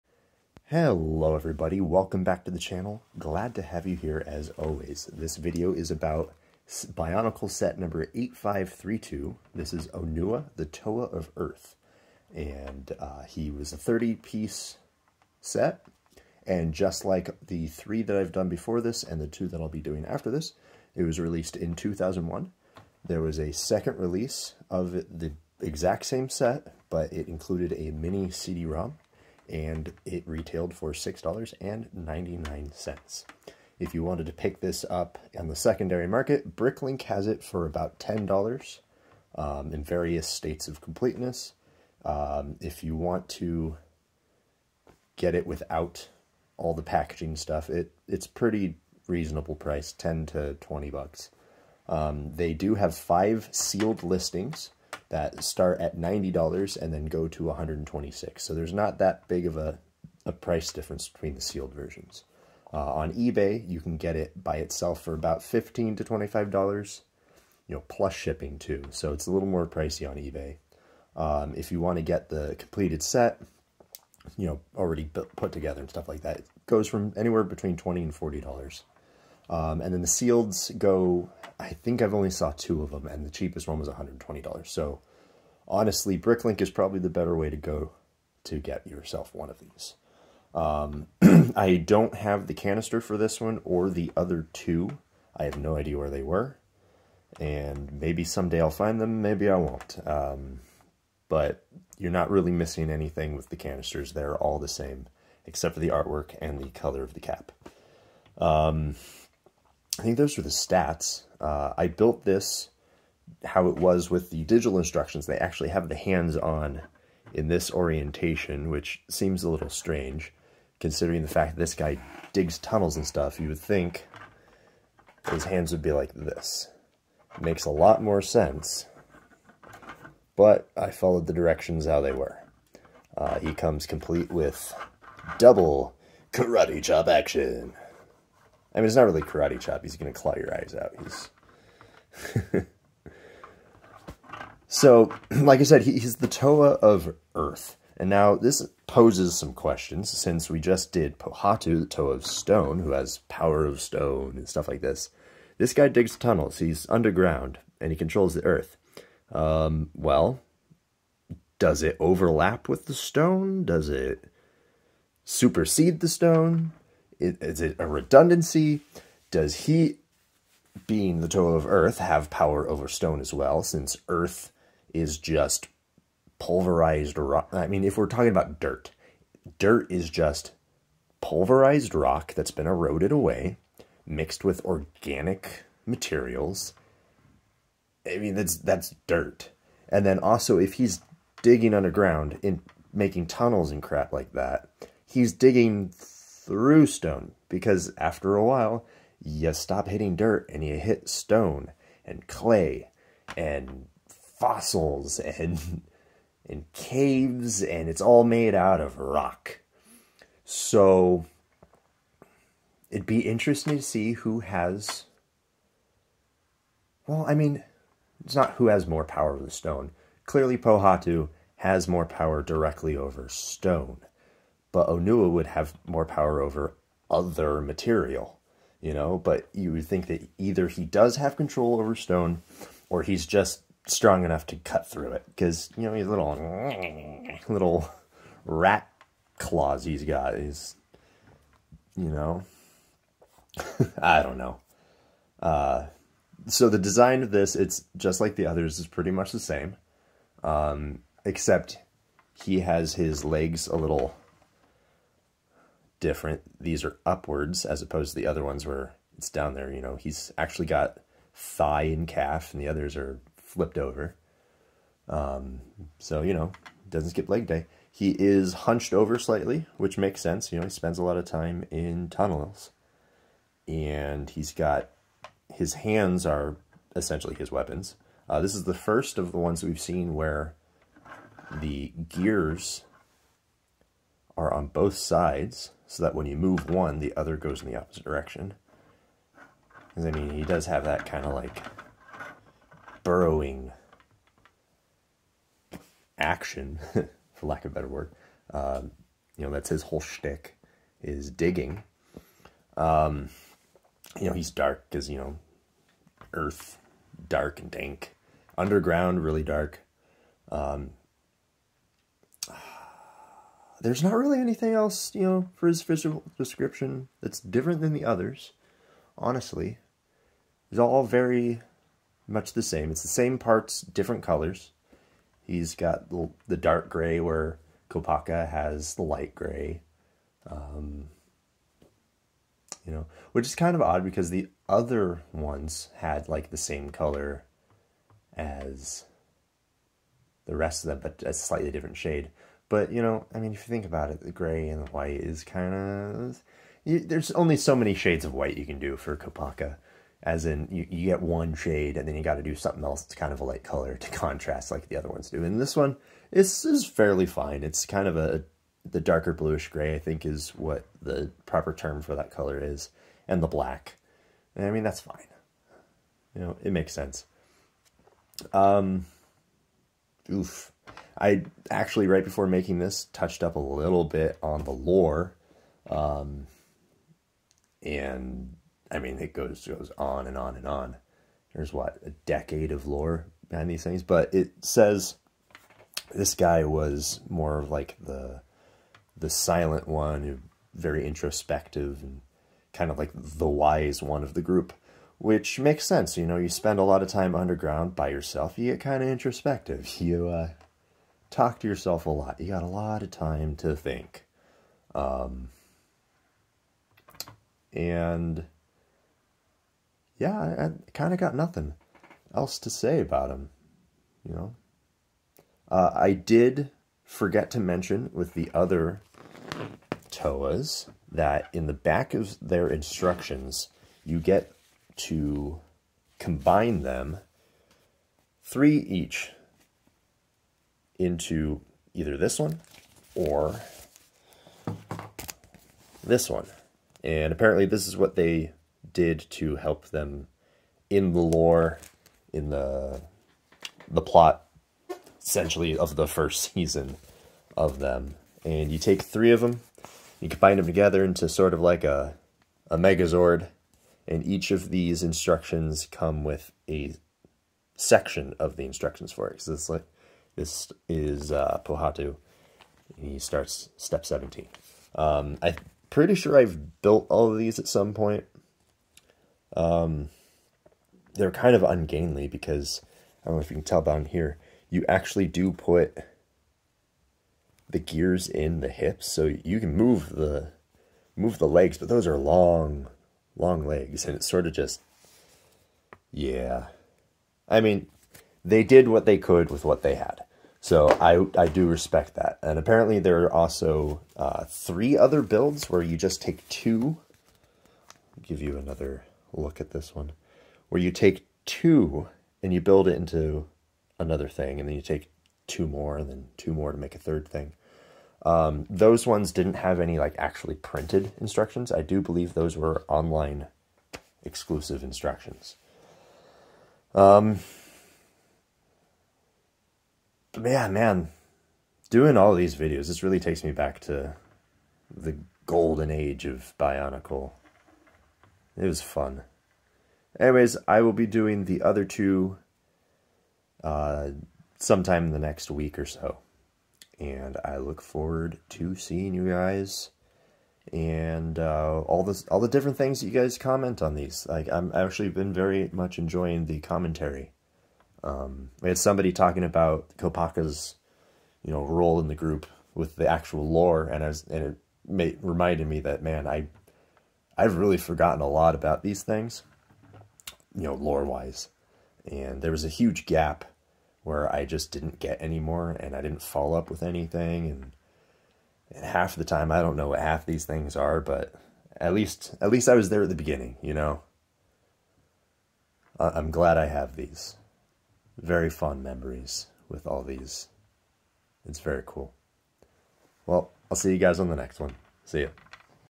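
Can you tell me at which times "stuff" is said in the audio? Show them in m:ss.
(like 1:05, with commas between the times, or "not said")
0:47, 1:15, 2:03, 2:34.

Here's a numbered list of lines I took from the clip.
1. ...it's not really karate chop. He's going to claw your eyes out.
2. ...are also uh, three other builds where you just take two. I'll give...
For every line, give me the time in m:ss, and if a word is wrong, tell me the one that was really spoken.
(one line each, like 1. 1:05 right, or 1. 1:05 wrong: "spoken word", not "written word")
1. 2:18 right
2. 8:13 right.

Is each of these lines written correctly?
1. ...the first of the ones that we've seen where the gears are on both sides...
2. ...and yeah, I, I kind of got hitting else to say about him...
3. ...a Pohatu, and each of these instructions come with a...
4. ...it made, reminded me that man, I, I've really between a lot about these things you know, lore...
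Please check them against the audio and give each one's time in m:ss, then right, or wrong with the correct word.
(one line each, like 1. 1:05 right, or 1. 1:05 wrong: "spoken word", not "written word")
1. 4:38 right
2. 6:47 wrong: "nothing", not "hitting"
3. 7:32 wrong: "Megazord", not "Pohatu"
4. 9:14 wrong: "forgotten", not "between".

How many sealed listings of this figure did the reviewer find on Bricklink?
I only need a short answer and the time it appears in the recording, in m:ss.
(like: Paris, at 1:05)
five, at 0:52.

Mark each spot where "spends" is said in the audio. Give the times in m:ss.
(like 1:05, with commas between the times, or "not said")
4:30, 6:36.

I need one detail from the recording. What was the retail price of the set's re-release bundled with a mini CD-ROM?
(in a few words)
$6.99.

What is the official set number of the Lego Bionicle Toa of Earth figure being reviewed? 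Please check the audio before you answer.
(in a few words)
8532.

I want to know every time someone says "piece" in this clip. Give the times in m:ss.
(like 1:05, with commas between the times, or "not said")
0:13.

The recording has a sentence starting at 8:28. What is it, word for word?
Um, those ones didn't have any like actually printed instructions.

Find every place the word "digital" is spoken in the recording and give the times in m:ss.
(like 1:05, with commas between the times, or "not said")
1:54.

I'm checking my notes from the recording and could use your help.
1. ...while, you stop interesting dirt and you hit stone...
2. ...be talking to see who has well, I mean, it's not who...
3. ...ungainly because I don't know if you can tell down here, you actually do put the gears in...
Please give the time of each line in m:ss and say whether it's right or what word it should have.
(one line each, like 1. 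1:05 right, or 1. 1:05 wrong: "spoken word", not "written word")
1. 3:18 wrong: "hitting", not "interesting"
2. 3:33 wrong: "interesting", not "talking"
3. 7:51 right.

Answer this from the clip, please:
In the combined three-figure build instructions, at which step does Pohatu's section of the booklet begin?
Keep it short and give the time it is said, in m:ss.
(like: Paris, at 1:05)
17, at 7:43.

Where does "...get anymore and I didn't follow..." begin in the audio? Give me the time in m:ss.
9:24.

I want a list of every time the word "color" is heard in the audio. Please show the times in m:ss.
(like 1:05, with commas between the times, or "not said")
1:46, 5:24, 5:36, 5:53, 6:02.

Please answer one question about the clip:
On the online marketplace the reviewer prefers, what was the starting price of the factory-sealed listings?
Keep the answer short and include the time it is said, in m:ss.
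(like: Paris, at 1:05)
$90, at 0:55.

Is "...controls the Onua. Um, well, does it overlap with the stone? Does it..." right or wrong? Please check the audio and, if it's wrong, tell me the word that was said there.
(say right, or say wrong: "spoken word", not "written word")
wrong: "Earth", not "Onua".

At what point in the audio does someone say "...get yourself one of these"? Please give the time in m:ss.
1:28.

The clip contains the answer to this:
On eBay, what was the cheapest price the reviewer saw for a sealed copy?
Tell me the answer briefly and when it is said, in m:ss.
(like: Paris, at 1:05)
$120, at 1:23.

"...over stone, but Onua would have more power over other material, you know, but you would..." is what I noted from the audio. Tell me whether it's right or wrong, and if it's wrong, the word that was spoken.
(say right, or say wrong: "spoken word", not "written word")
right.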